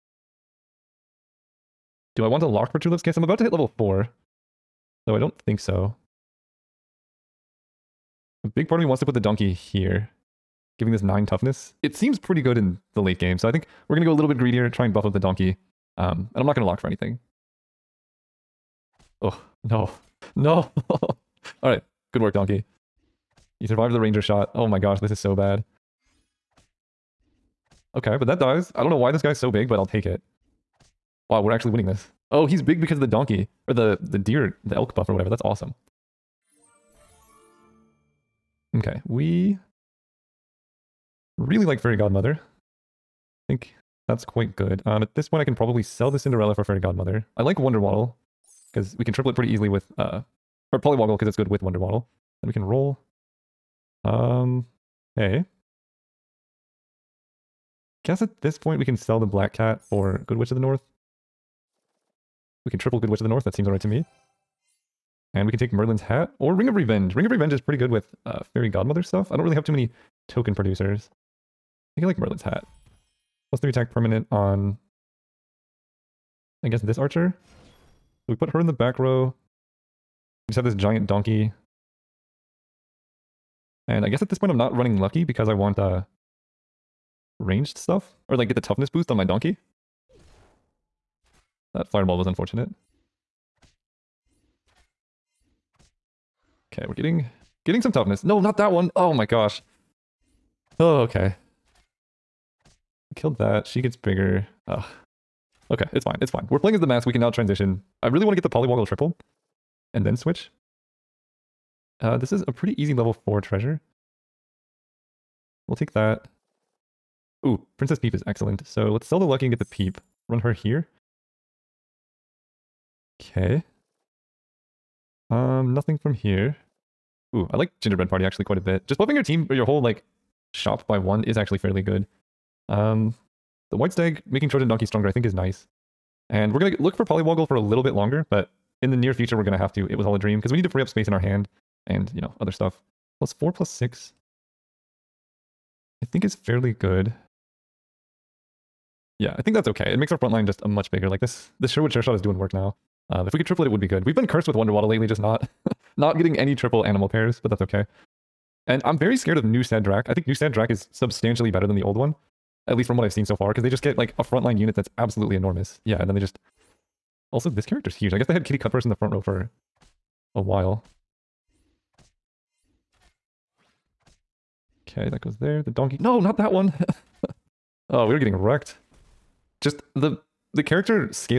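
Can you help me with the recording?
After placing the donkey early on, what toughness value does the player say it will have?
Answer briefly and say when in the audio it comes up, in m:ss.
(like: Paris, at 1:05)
9, at 0:11.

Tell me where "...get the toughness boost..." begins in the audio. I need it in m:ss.
1:28.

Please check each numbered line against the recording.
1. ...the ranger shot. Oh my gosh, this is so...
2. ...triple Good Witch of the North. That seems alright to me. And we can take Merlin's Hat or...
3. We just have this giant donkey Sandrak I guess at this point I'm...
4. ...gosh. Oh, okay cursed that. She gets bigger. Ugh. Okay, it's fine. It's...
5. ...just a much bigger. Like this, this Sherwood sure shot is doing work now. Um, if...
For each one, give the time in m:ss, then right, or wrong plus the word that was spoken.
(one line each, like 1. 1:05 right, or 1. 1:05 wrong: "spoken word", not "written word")
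1. 0:23 right
2. 1:02 right
3. 1:20 wrong: "And", not "Sandrak"
4. 1:39 wrong: "killed", not "cursed"
5. 2:30 right.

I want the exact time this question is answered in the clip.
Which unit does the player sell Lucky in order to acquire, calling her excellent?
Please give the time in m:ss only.
1:57.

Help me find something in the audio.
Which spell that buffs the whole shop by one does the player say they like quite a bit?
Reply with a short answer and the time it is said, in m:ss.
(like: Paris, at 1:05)
Gingerbread Party, at 2:07.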